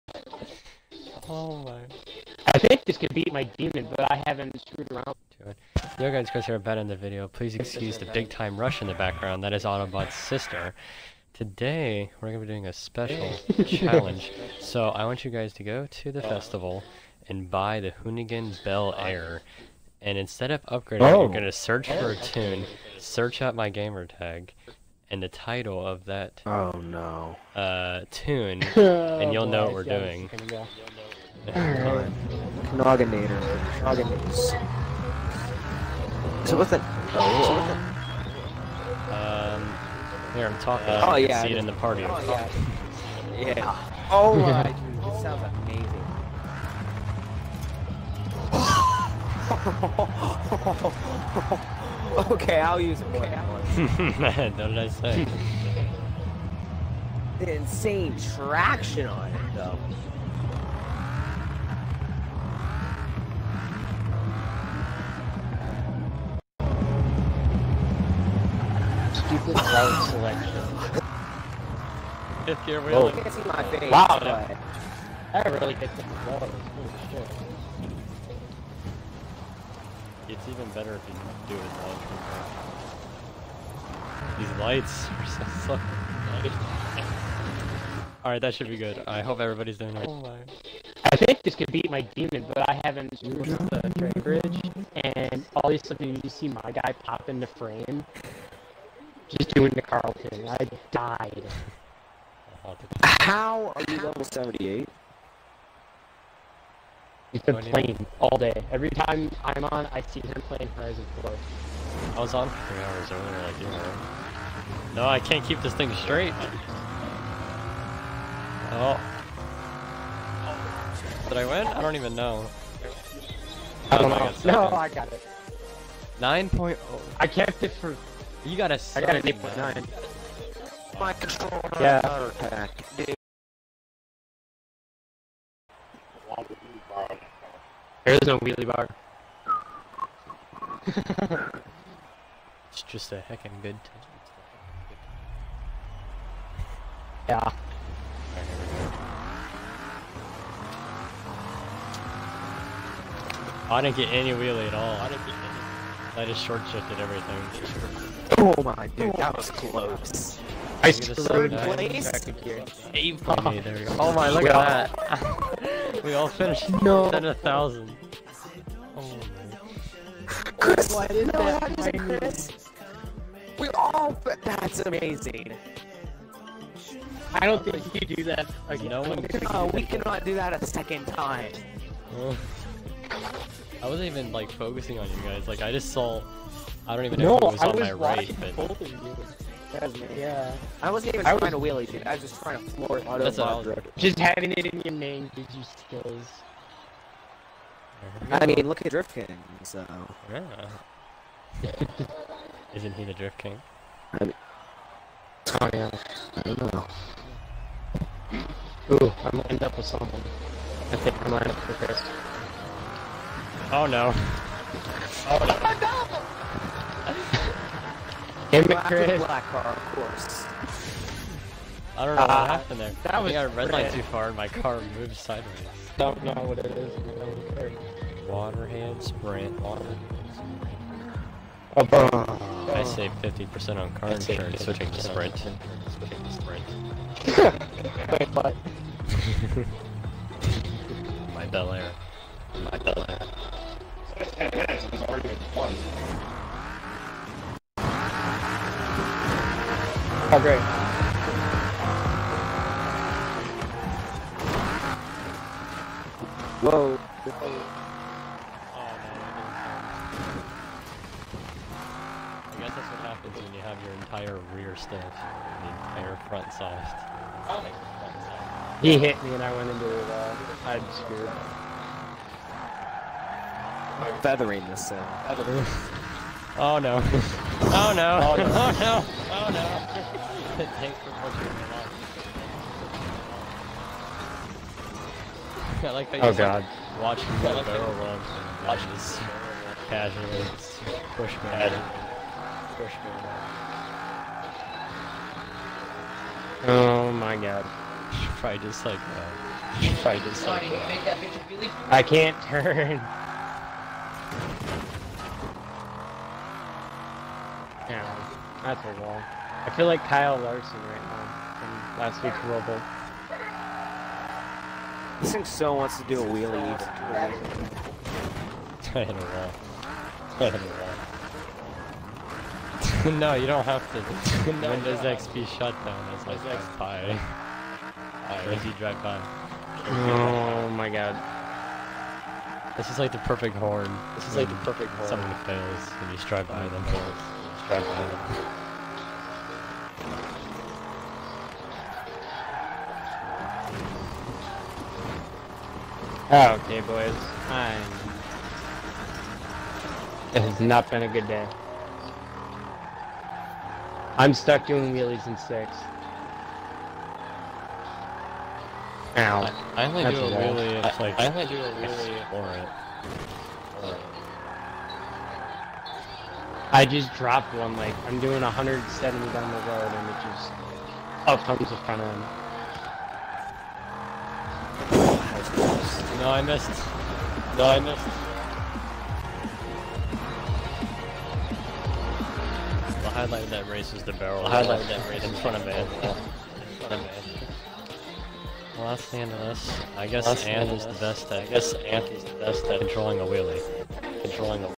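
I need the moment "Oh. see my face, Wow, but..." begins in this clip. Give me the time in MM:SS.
01:11.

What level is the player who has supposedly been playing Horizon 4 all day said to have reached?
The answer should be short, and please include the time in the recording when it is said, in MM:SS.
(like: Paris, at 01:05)
78, at 01:44.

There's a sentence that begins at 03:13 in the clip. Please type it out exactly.
Just having it in your name gives you skills.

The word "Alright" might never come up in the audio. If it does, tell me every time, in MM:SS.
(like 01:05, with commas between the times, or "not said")
00:31, 01:28.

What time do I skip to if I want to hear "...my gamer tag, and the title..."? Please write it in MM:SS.
00:23.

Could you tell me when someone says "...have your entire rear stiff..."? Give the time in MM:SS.
04:23.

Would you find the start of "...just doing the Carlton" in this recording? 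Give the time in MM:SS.
01:39.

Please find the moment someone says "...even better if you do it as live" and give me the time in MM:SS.
01:20.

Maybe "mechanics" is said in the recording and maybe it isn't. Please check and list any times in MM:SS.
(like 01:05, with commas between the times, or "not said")
not said.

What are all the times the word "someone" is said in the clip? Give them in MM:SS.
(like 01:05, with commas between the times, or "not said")
03:29, 05:35.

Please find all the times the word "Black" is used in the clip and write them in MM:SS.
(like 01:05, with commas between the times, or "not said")
03:39.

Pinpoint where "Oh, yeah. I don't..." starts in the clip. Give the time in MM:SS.
03:25.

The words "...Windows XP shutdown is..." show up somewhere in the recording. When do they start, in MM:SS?
05:24.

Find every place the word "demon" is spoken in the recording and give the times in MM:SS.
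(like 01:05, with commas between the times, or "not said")
00:03, 01:32.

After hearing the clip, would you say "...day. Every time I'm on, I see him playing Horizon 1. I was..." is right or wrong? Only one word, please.
wrong.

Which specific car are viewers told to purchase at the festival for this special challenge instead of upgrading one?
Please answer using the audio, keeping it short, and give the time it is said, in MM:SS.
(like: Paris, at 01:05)
Hoonigan Bel Air, at 00:18.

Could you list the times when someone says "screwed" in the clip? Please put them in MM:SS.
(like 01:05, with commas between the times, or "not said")
00:04, 04:30.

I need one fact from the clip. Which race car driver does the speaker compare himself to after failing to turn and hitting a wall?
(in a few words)
Kyle Larson.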